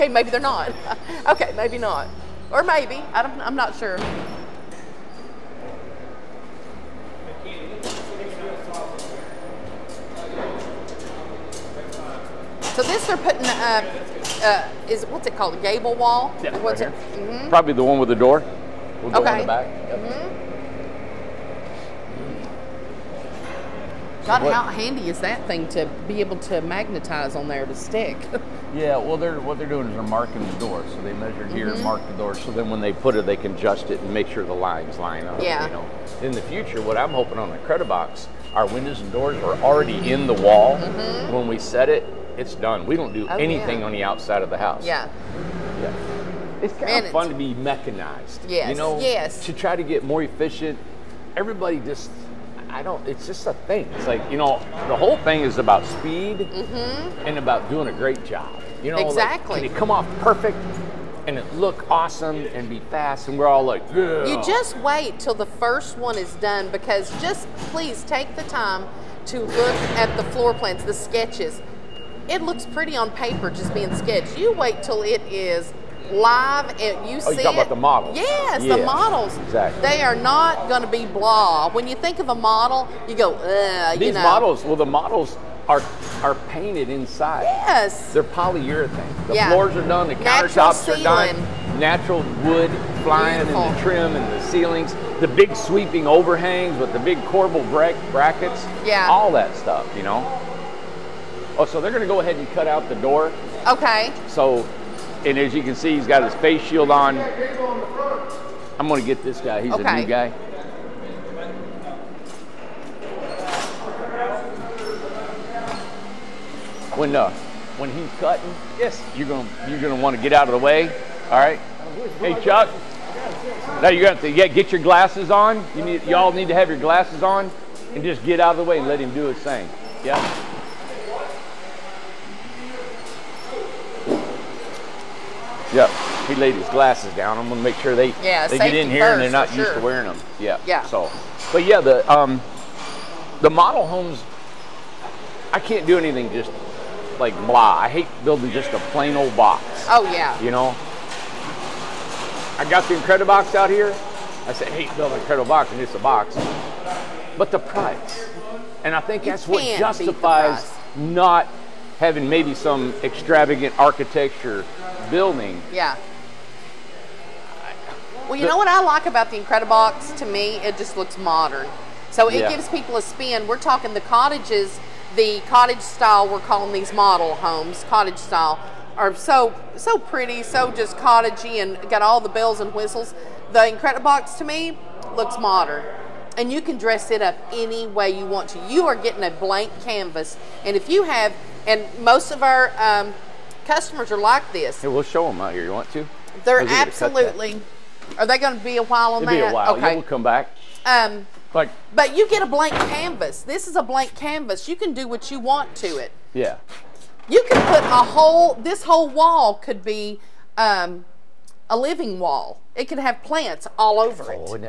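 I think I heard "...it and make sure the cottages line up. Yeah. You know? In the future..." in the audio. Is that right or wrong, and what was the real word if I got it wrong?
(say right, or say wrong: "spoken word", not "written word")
wrong: "lines", not "cottages".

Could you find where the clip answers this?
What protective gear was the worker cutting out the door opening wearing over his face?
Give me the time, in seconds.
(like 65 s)
106 s.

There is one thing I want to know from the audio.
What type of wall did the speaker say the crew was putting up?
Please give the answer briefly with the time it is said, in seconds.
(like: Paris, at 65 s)
Gable wall, at 15 s.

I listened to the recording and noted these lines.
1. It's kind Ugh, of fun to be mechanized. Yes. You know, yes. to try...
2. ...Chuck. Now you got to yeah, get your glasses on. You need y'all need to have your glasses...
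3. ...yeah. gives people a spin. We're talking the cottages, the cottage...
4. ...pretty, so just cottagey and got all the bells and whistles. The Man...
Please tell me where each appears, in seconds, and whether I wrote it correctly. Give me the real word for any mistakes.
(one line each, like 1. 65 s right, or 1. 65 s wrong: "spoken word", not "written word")
1. 46 s wrong: "Man", not "Ugh"
2. 122 s right
3. 172 s right
4. 179 s wrong: "Incredibox", not "Man".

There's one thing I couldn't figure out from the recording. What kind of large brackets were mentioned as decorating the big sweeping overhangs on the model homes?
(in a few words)
Corbel brackets.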